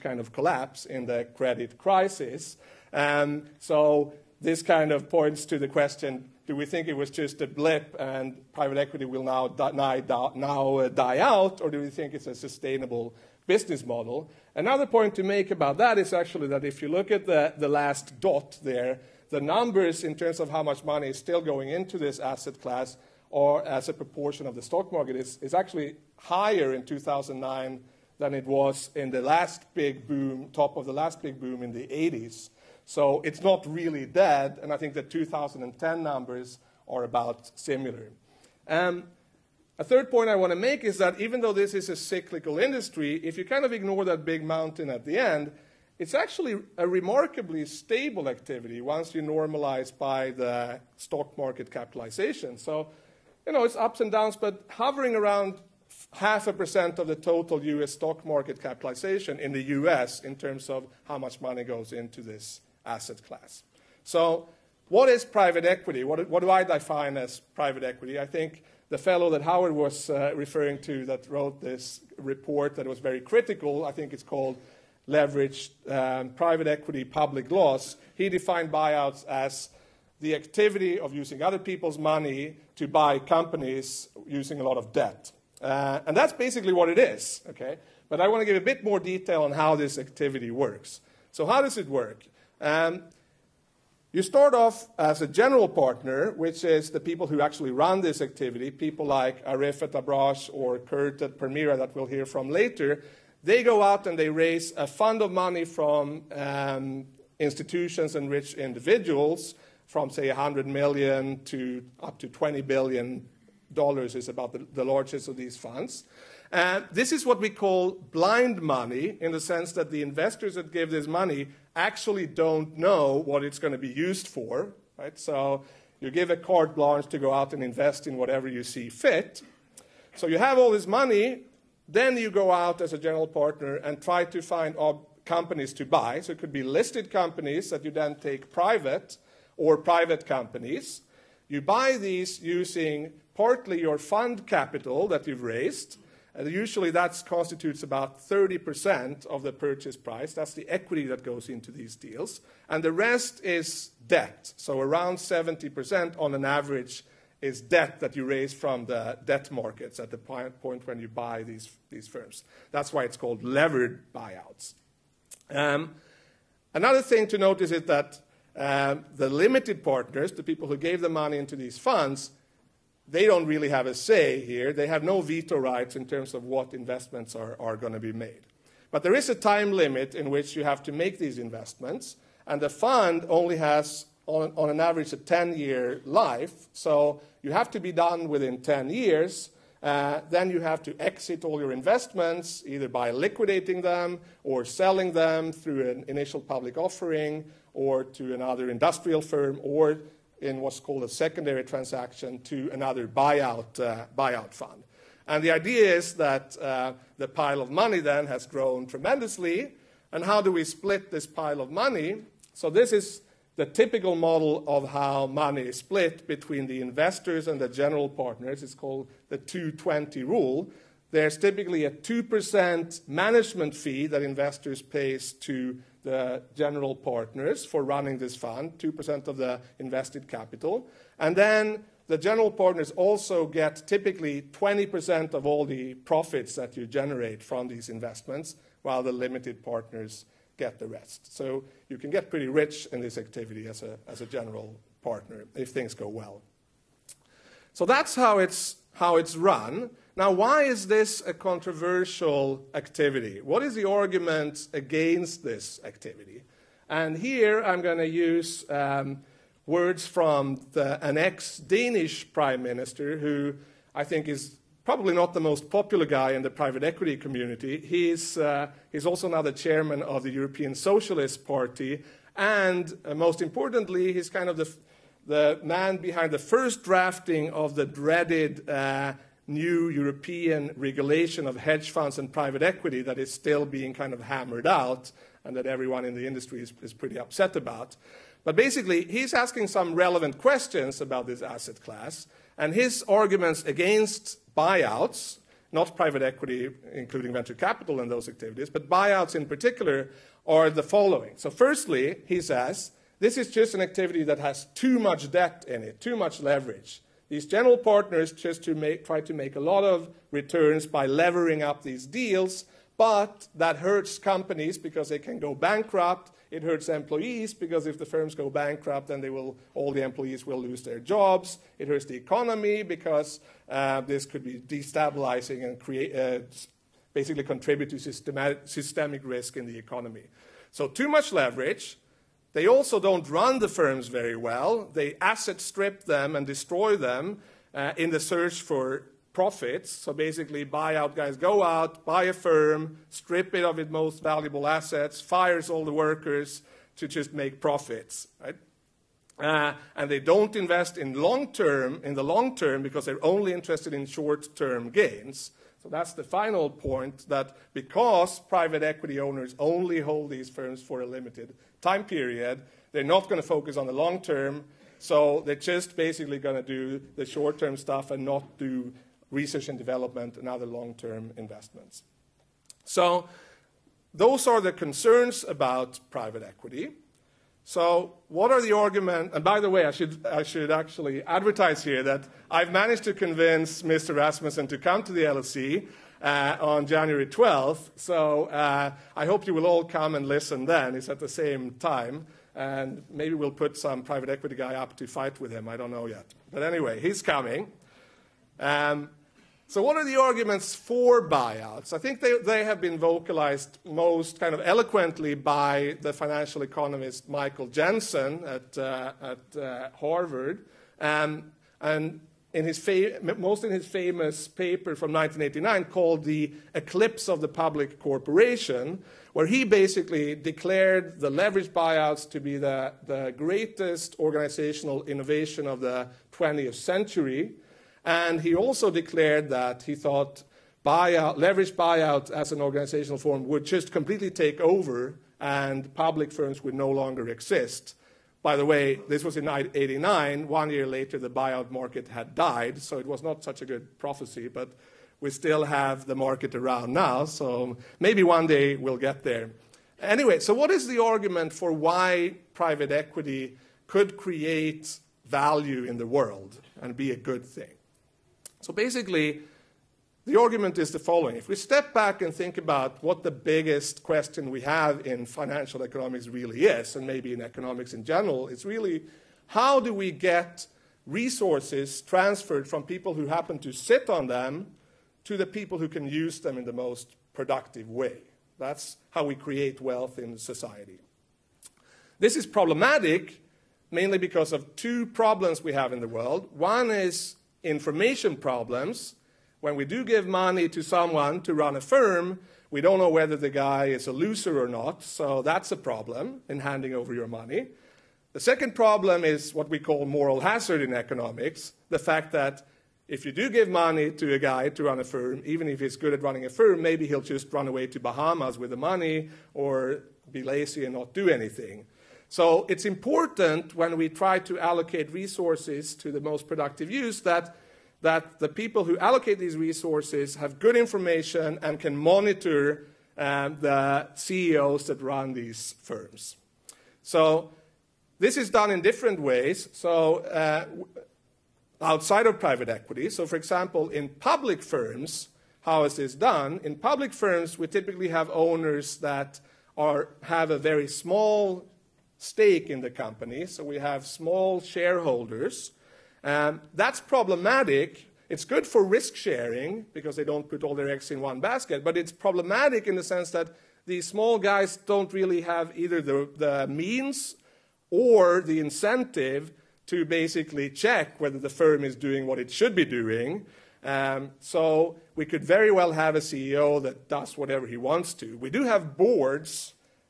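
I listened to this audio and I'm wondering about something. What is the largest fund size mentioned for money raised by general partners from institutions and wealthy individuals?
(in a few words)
20 billion dollars.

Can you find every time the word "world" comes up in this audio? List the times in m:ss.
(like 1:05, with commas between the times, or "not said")
7:36, 8:06.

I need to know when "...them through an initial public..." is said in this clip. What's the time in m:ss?
3:15.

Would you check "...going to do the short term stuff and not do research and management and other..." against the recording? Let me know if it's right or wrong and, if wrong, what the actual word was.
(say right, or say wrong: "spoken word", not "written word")
wrong: "development", not "management".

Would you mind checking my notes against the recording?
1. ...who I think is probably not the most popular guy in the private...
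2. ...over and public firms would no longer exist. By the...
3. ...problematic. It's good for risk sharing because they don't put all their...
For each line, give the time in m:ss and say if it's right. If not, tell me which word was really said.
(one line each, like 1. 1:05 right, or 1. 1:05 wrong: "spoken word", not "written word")
1. 4:23 right
2. 7:14 right
3. 9:06 right.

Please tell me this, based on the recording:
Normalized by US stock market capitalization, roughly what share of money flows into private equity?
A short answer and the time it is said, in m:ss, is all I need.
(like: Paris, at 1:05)
half a percent, at 0:56.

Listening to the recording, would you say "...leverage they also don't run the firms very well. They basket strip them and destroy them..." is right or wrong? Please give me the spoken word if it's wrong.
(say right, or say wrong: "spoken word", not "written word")
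wrong: "asset", not "basket".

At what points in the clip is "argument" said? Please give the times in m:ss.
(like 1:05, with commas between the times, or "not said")
4:13, 4:53, 6:18, 6:40, 7:30, 7:40.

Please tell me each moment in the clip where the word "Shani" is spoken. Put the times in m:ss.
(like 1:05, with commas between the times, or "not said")
not said.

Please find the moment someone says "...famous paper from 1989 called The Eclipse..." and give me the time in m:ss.
6:53.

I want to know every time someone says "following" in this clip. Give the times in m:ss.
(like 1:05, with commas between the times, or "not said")
5:00, 7:40.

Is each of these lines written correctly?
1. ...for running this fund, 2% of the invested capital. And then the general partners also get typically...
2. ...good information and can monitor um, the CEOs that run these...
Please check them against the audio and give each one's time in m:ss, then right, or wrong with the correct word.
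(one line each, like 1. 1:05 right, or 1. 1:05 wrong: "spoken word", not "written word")
1. 3:47 right
2. 8:40 right.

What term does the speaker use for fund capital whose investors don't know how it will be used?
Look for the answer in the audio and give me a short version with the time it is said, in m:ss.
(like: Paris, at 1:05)
blind money, at 1:58.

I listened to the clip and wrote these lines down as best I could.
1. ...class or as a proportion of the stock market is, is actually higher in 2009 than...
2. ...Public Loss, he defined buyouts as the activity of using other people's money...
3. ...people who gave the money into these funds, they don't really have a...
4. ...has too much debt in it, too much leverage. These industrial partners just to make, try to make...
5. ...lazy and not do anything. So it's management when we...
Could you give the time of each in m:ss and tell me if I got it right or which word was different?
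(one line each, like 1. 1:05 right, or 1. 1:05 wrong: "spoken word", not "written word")
1. 0:22 right
2. 1:17 right
3. 2:50 right
4. 5:04 wrong: "general", not "industrial"
5. 8:30 wrong: "important", not "management".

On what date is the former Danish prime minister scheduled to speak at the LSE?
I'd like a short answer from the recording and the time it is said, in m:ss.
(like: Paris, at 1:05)
January 12th, at 6:26.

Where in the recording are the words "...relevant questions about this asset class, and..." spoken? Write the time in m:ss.
4:49.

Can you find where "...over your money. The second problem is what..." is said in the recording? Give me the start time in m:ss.
8:16.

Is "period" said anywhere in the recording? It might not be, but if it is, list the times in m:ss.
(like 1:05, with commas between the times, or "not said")
6:02.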